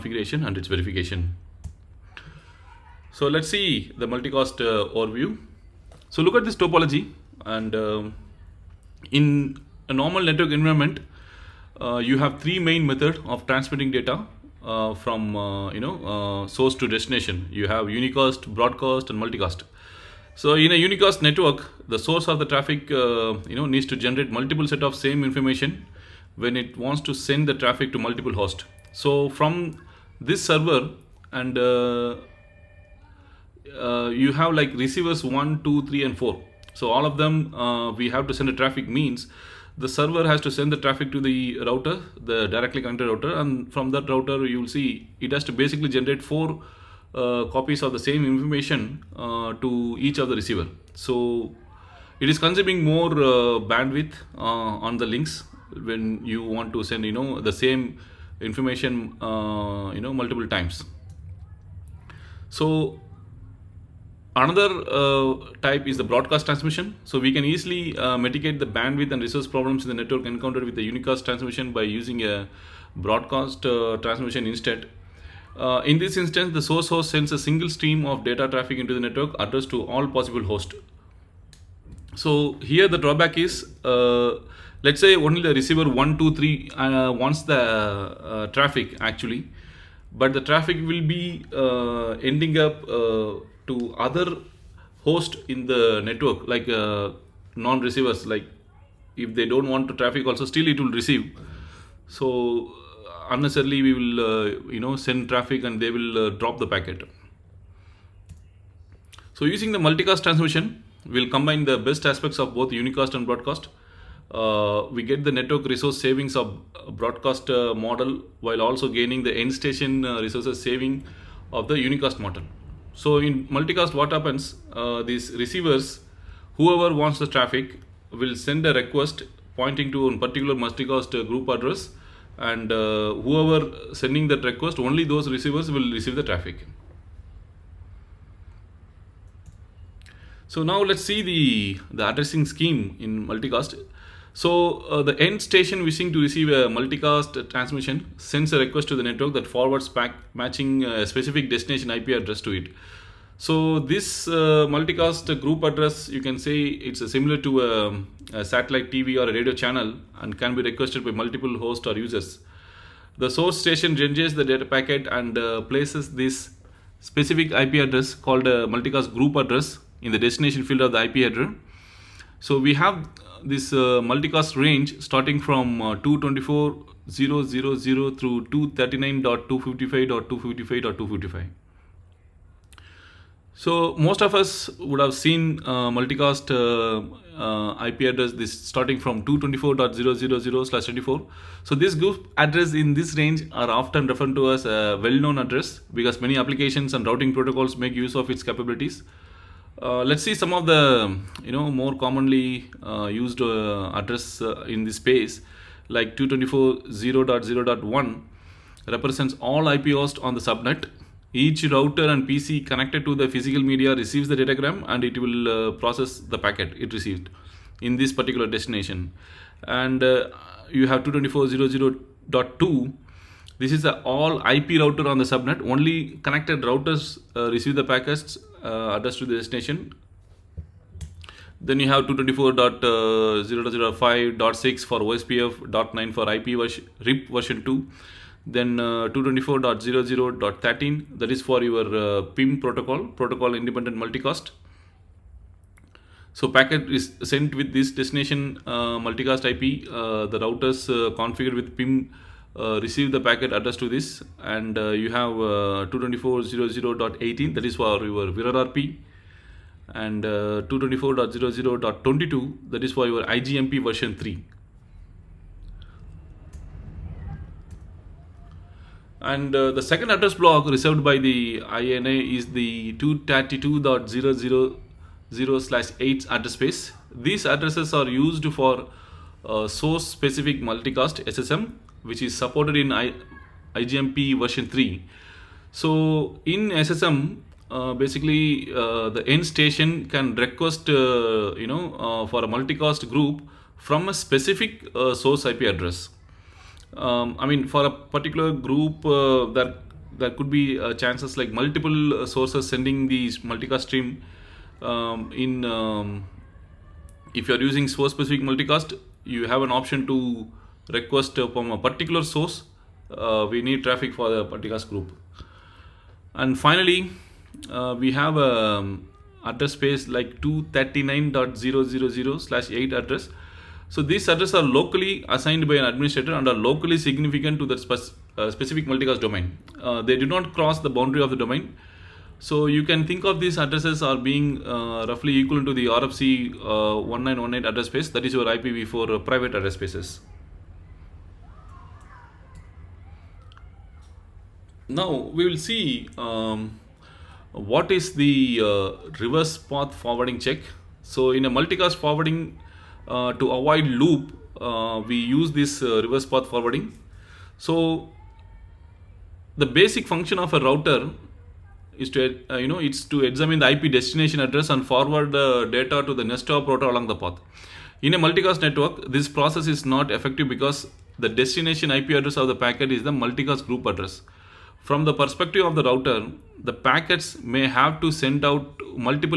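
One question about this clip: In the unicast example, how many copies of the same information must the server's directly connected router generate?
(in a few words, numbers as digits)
4.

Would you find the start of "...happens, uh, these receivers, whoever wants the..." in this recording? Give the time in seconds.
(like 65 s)
124 s.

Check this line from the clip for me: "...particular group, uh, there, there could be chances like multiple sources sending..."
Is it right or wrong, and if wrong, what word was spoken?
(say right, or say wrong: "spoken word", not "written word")
right.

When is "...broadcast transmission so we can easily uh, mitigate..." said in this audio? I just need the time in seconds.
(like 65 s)
66 s.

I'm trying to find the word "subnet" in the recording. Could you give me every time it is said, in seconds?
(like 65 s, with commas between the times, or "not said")
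210 s, 225 s.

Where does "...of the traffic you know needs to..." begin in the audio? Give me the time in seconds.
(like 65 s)
22 s.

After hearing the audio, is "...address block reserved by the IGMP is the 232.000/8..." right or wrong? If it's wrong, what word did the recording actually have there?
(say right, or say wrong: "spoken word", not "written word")
wrong: "IANA", not "IGMP".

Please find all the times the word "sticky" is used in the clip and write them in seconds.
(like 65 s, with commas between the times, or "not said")
not said.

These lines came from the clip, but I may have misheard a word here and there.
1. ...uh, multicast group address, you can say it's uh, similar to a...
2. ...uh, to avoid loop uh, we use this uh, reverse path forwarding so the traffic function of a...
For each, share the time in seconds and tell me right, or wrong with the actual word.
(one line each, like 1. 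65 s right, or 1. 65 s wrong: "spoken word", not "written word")
1. 154 s right
2. 353 s wrong: "basic", not "traffic".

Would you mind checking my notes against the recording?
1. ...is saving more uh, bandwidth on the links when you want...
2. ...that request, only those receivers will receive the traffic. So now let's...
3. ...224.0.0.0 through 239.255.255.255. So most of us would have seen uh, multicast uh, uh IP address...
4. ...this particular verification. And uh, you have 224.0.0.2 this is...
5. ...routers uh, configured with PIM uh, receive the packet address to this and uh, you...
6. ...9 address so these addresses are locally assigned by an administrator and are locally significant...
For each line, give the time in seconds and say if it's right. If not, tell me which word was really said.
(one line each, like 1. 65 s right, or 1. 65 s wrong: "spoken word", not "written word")
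1. 52 s wrong: "consuming", not "saving"
2. 134 s right
3. 175 s right
4. 217 s wrong: "destination", not "verification"
5. 250 s right
6. 322 s wrong: "8", not "9".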